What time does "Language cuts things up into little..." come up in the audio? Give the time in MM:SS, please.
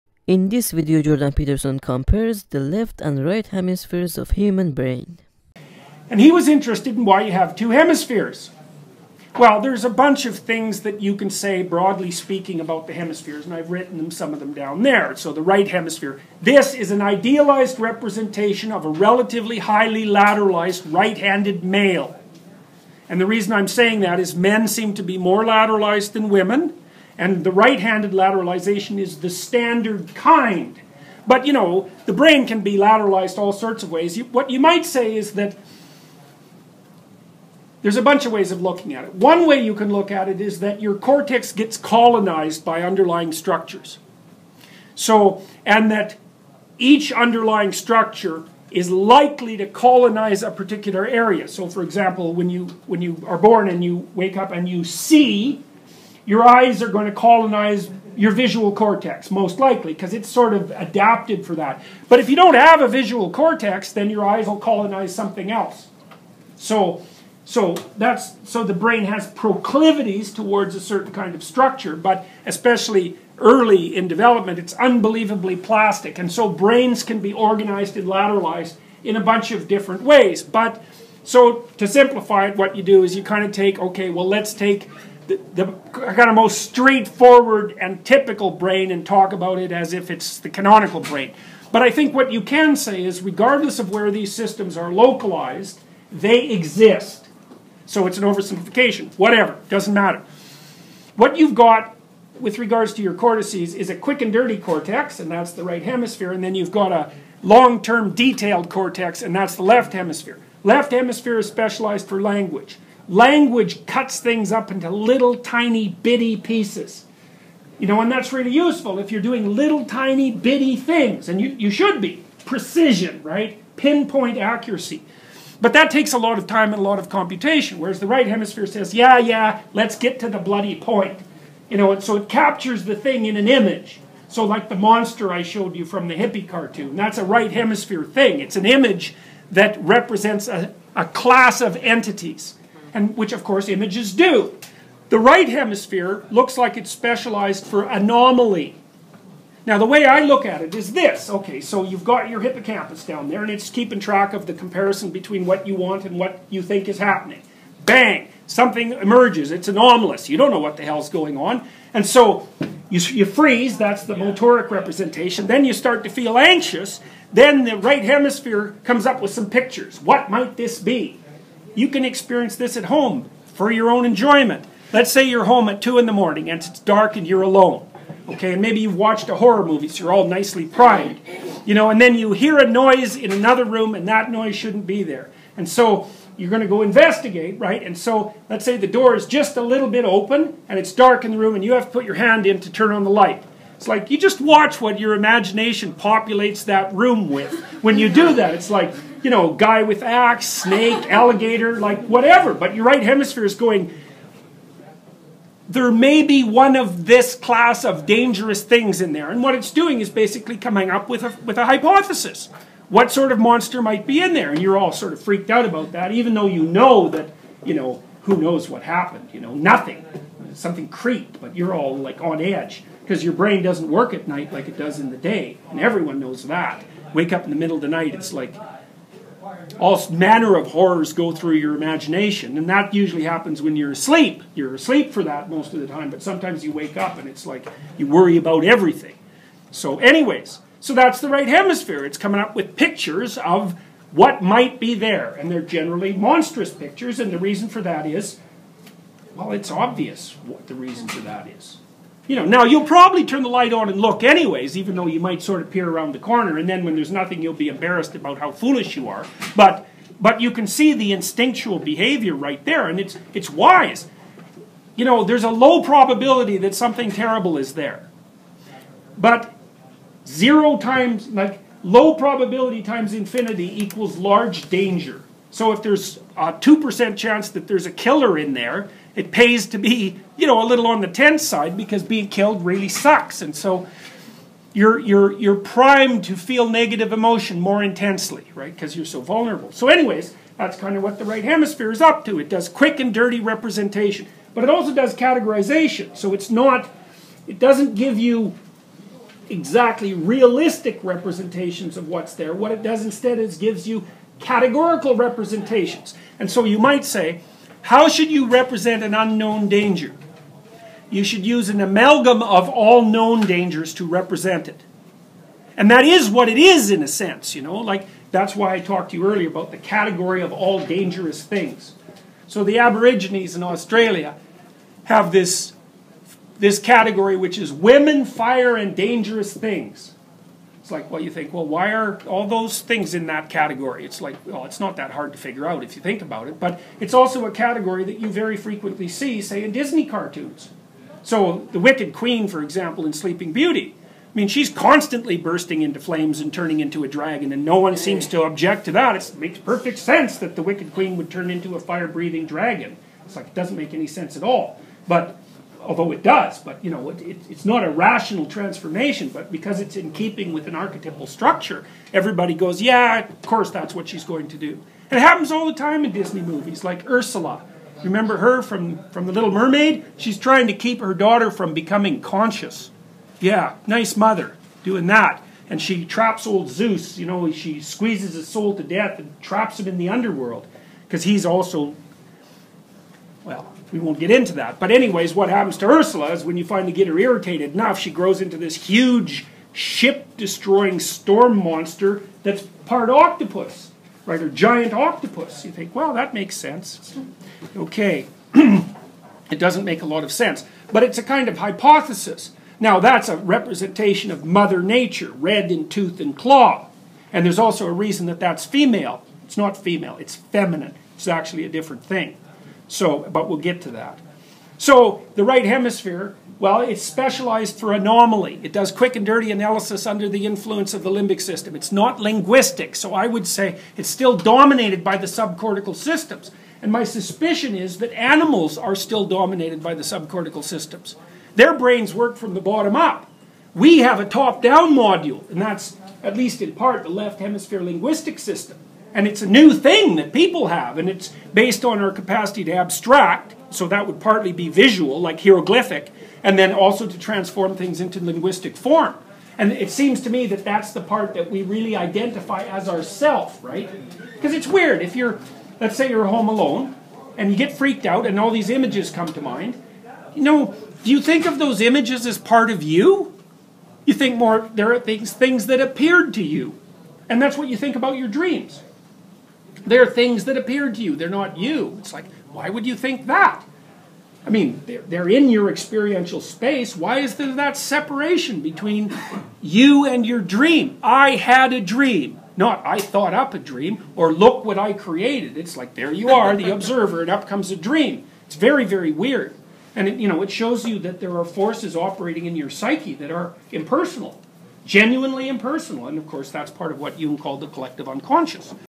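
01:53.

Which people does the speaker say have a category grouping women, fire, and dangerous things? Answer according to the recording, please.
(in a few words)
Aborigines in Australia.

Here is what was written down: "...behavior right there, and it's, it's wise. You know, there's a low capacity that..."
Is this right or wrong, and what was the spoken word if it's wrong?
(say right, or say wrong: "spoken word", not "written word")
wrong: "probability", not "capacity".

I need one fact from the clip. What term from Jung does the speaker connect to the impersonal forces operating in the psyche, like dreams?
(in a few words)
Collective unconscious.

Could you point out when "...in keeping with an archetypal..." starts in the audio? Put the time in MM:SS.
05:59.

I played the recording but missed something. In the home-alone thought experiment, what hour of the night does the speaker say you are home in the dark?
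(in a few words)
2 in the morning.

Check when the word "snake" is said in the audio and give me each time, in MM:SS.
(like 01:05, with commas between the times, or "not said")
03:20.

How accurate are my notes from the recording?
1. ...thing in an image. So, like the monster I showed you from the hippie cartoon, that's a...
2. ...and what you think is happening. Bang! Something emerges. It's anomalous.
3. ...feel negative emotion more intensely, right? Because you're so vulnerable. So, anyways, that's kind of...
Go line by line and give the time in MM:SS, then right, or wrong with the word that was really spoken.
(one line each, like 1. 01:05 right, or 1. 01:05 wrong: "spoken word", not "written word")
1. 02:12 right
2. 02:36 right
3. 04:46 right.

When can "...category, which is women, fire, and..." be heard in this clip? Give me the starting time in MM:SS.
05:26.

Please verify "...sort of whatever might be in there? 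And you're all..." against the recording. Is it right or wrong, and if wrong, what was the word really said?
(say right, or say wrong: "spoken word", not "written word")
wrong: "monster", not "whatever".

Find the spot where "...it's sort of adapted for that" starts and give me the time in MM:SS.
01:00.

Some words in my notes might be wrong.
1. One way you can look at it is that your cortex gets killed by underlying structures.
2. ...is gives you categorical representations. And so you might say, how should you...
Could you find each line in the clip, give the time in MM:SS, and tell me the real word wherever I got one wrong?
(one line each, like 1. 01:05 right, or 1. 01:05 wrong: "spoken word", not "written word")
1. 00:39 wrong: "colonized", not "killed"
2. 05:03 right.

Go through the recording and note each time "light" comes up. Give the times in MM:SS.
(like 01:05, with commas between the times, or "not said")
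03:13, 04:13.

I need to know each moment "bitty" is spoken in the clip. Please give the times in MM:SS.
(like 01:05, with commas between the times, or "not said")
01:55, 02:00.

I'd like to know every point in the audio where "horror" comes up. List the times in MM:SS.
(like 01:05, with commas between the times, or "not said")
02:59, 03:50.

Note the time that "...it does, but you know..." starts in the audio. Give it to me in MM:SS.
05:56.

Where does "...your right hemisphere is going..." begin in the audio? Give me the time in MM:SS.
03:22.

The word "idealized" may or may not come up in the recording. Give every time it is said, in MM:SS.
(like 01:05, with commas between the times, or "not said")
00:17.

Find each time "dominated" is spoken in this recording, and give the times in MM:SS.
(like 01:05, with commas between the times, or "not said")
07:04, 07:09.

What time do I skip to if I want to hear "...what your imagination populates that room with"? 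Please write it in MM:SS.
03:14.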